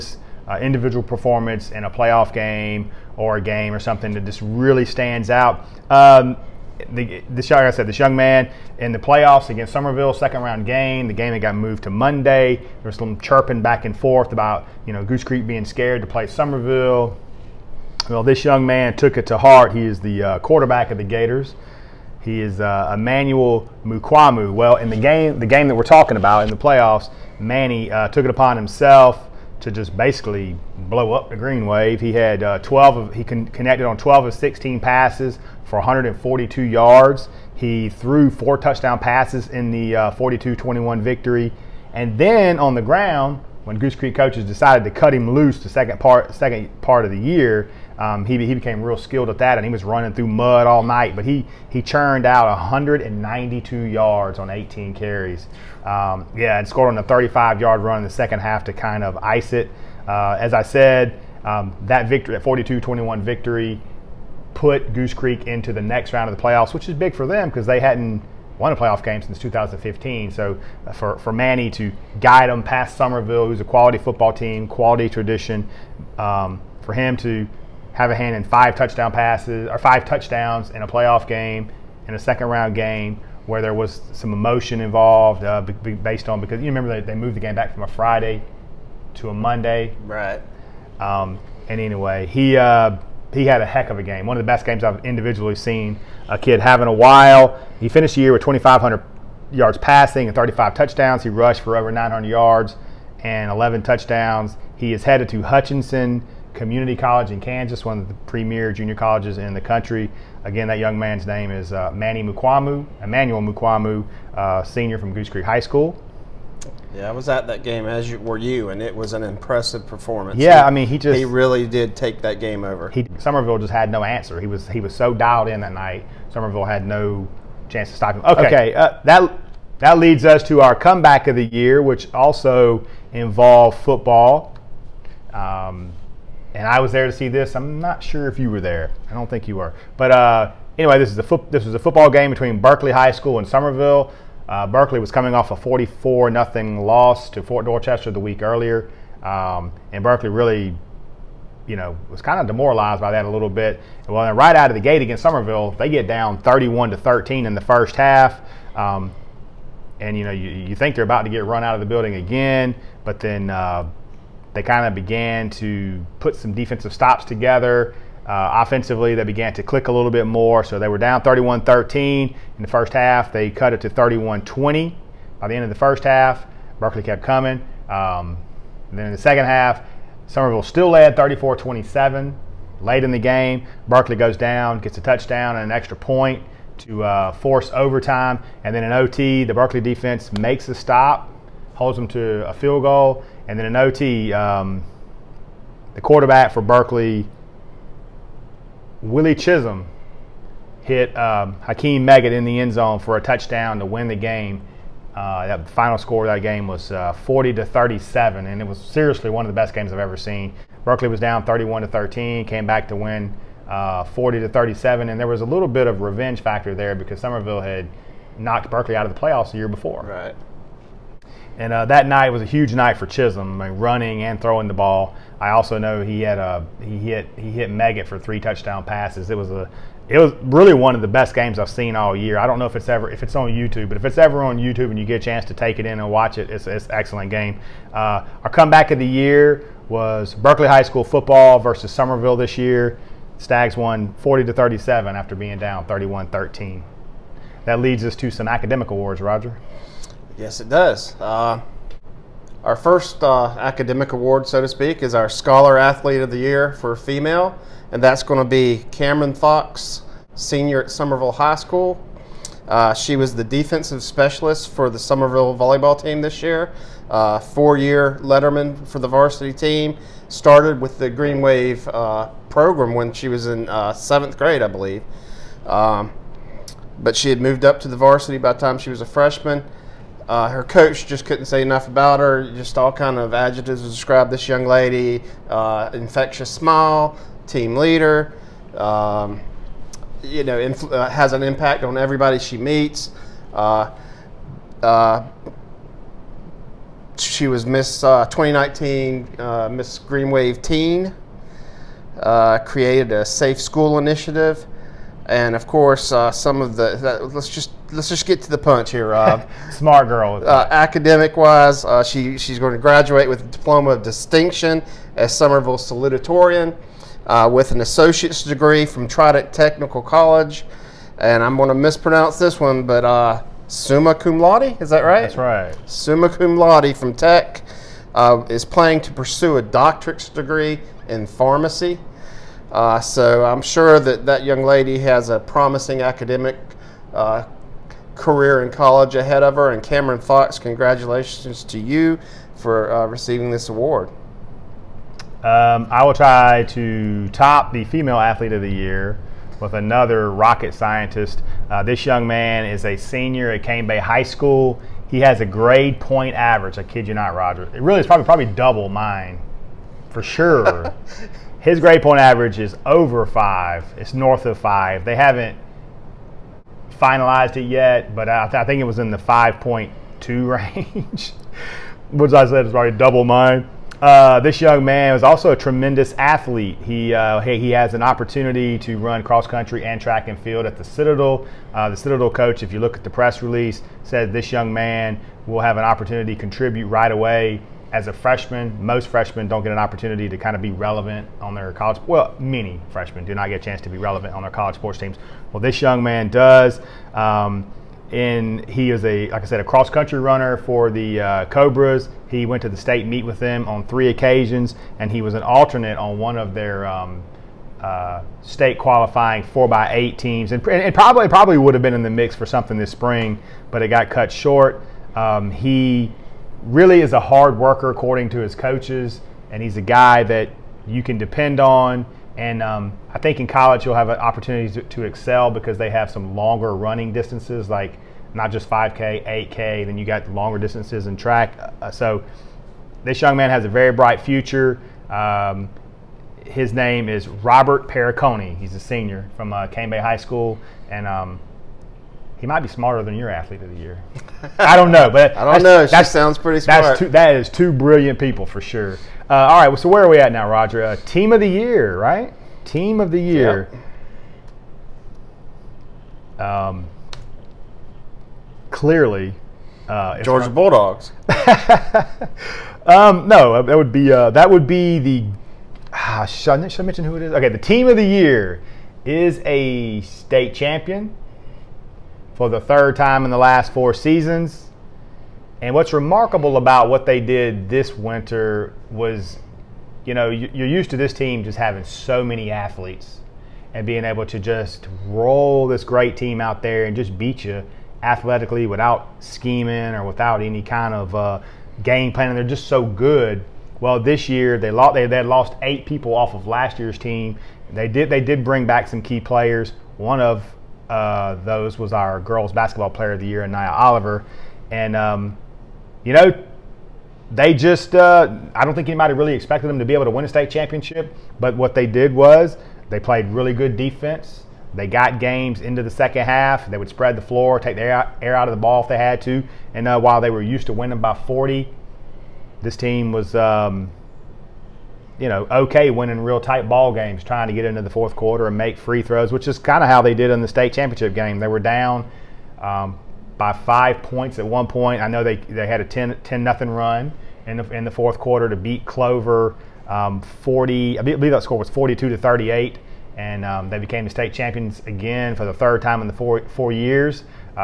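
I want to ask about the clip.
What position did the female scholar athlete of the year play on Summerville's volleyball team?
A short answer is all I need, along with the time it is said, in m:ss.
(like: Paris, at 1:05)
Defensive specialist, at 4:23.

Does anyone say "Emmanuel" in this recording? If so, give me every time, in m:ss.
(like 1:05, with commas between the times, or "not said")
0:22, 1:53.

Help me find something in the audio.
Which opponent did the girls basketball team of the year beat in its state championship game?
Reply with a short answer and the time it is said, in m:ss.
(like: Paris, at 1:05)
Clover, at 8:58.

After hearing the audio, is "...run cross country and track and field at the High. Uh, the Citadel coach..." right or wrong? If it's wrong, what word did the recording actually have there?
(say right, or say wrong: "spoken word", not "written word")
wrong: "Citadel", not "High".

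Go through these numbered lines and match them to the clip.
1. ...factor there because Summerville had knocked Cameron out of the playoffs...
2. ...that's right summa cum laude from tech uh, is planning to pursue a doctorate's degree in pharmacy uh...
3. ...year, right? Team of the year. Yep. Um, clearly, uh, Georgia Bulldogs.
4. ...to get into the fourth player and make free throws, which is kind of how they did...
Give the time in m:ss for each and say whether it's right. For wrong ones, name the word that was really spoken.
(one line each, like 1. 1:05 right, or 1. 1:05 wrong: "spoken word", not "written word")
1. 3:36 wrong: "Berkeley", not "Cameron"
2. 5:25 right
3. 7:31 right
4. 8:47 wrong: "quarter", not "player".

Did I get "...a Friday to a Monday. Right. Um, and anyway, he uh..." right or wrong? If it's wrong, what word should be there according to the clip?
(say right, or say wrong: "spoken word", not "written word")
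right.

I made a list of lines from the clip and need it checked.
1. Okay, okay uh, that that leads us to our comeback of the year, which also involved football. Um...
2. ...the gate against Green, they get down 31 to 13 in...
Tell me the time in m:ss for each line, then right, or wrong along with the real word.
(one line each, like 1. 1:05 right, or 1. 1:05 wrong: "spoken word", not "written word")
1. 2:08 right
2. 2:34 wrong: "Summerville", not "Green".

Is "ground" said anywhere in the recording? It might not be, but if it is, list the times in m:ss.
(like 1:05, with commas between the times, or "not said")
0:42.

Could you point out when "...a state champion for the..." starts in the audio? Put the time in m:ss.
7:49.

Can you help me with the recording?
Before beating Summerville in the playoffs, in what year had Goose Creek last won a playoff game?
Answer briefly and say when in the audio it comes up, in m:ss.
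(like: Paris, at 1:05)
2015, at 1:09.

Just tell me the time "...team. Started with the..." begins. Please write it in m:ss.
4:29.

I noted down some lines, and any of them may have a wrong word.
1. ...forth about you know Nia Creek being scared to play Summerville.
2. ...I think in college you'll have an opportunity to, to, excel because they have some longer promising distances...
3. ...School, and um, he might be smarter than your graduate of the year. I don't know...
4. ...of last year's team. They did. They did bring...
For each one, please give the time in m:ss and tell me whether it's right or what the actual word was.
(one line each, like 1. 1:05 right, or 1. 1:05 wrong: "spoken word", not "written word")
1. 0:13 wrong: "Goose", not "Nia"
2. 7:03 wrong: "running", not "promising"
3. 7:20 wrong: "athlete", not "graduate"
4. 8:16 right.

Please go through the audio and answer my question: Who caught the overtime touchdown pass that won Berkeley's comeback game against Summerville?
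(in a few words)
Hakeem Meggett.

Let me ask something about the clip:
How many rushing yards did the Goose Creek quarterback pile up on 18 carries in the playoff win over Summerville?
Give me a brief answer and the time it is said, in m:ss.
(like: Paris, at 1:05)
192, at 0:52.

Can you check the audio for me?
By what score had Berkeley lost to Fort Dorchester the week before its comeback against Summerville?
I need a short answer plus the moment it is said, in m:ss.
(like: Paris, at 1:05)
44-0, at 2:25.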